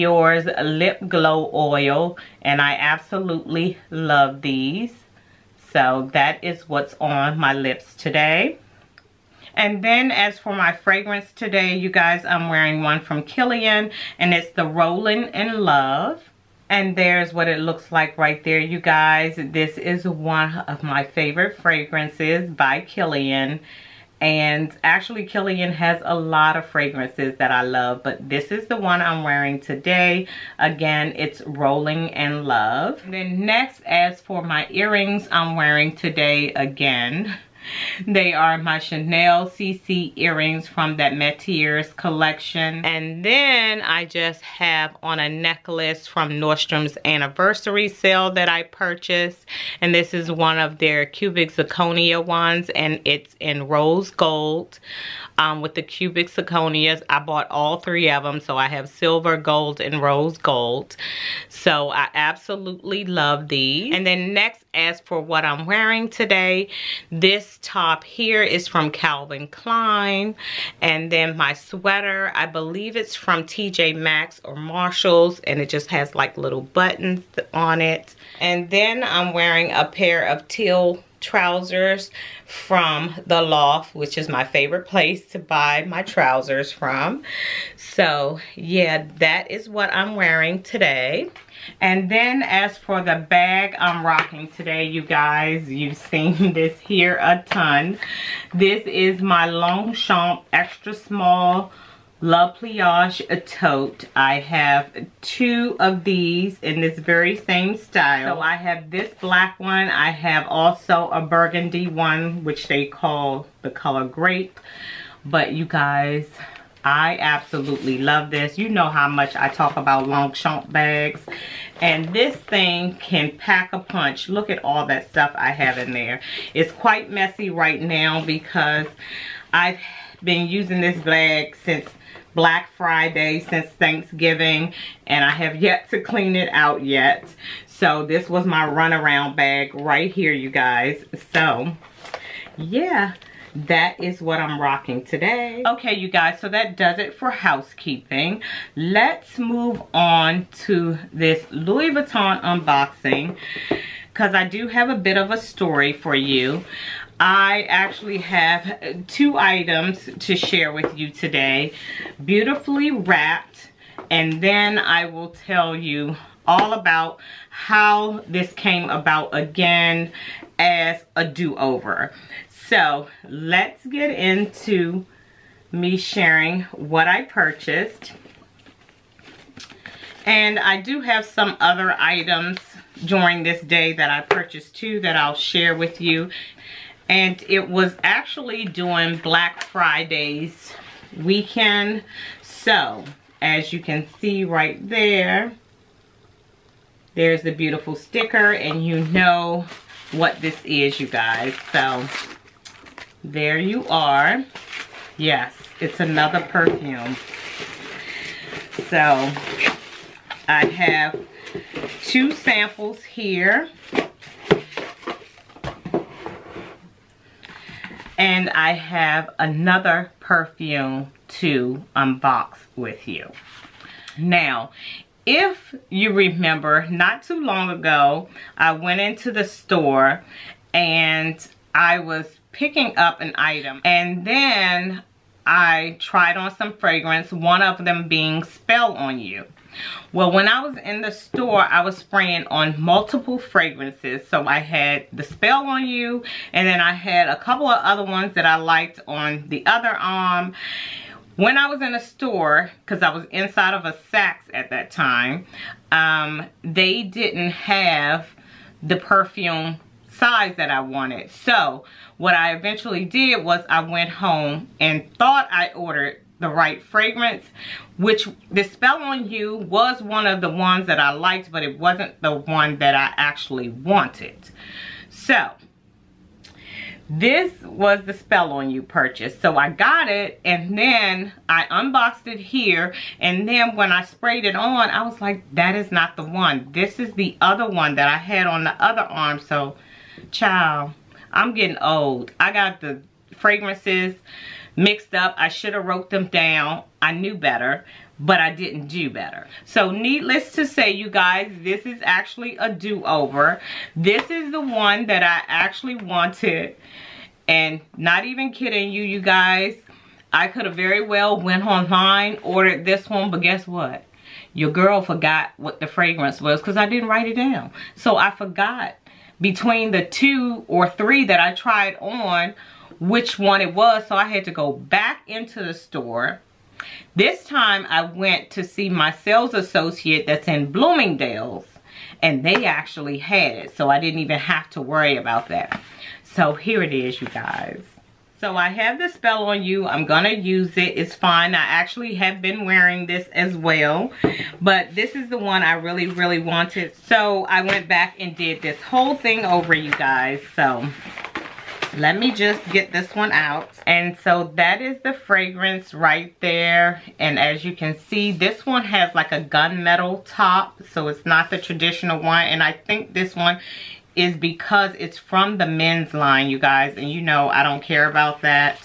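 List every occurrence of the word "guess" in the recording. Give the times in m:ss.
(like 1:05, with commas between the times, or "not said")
5:13.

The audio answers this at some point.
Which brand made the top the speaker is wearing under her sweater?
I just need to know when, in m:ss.
1:08.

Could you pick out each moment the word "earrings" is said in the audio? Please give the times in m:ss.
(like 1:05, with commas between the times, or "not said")
0:34, 0:40.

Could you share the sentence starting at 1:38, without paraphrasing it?
This is my Longchamp extra small La Pliage tote.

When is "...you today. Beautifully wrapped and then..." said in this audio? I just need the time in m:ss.
2:40.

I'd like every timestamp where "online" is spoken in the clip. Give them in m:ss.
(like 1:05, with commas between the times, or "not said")
5:11.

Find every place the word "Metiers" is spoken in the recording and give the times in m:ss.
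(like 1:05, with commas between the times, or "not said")
0:41.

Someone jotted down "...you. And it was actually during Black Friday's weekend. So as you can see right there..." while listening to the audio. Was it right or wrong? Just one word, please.
right.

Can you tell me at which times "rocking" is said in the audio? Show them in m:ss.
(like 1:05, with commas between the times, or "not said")
1:34, 2:24.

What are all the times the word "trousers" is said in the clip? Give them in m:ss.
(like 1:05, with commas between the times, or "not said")
1:21, 1:26.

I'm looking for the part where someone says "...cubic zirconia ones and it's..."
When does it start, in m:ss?
0:51.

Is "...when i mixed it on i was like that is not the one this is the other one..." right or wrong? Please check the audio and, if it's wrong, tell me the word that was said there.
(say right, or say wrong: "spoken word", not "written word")
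wrong: "sprayed", not "mixed".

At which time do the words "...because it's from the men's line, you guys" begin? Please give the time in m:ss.
6:04.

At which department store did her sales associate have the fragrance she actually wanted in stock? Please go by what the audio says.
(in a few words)
Bloomingdale's.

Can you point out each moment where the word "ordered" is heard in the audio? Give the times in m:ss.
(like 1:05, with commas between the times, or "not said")
4:25, 5:12.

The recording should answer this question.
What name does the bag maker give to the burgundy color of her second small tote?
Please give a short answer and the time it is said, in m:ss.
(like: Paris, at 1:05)
grape, at 1:53.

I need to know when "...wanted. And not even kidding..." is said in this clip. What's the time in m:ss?
5:05.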